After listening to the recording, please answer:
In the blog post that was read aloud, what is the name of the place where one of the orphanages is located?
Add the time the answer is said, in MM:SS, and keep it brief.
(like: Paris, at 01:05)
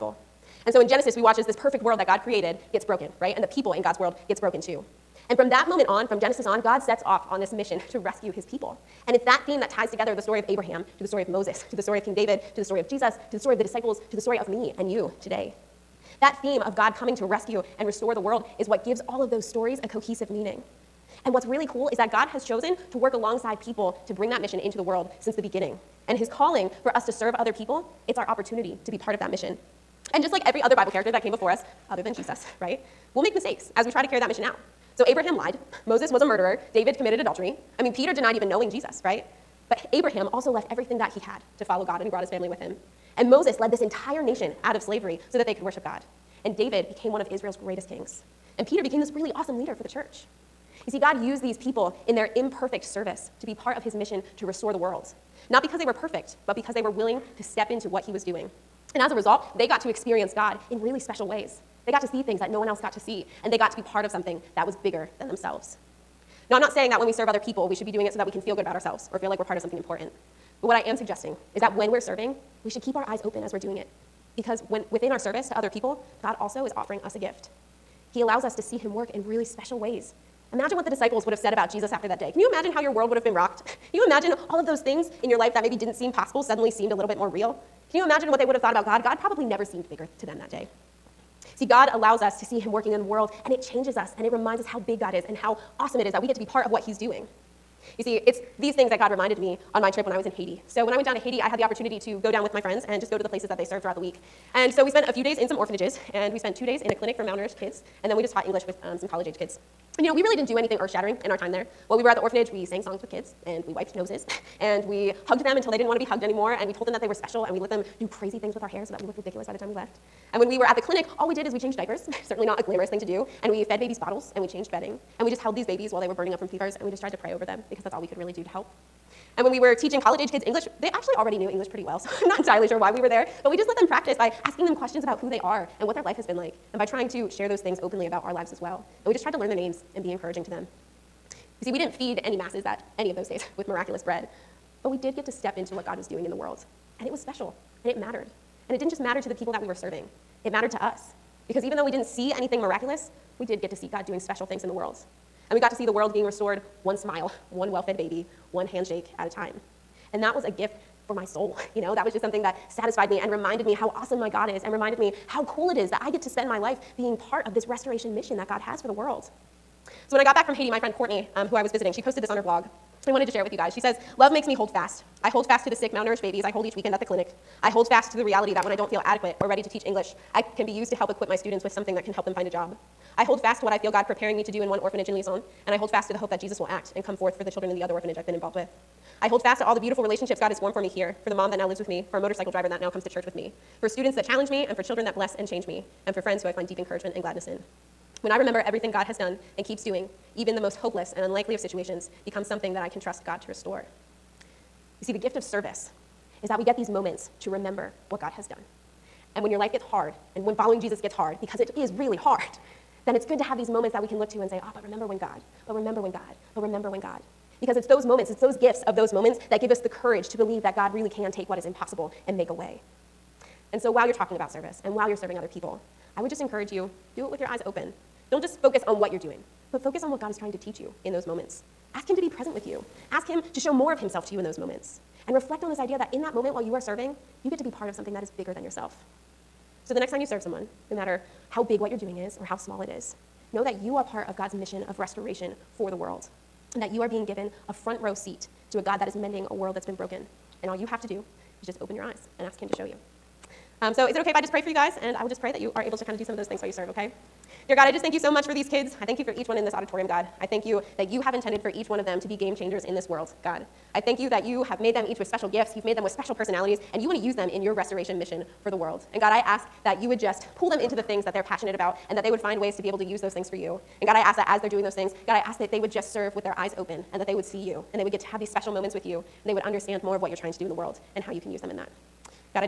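Lison, at 03:05.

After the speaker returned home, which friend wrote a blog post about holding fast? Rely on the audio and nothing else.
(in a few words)
Courtney.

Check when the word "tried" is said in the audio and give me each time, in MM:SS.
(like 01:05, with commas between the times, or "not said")
02:07, 02:19.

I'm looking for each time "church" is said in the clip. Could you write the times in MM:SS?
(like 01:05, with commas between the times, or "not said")
00:49, 03:13.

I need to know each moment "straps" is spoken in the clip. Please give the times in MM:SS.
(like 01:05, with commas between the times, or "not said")
not said.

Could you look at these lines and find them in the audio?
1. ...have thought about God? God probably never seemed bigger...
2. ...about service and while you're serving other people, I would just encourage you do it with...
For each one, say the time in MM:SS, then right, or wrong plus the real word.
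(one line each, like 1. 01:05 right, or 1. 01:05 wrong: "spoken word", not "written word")
1. 01:28 right
2. 03:44 right.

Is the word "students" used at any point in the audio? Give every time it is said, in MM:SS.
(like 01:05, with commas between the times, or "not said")
03:01, 03:13.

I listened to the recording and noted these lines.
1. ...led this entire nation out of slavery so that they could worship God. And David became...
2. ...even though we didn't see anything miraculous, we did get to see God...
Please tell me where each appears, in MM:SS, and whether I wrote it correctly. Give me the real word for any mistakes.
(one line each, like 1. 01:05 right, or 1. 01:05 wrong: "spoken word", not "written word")
1. 00:43 right
2. 02:31 right.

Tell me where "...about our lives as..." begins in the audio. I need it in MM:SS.
02:18.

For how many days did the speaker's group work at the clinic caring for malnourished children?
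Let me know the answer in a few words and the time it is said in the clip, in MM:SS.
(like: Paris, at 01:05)
2, at 01:46.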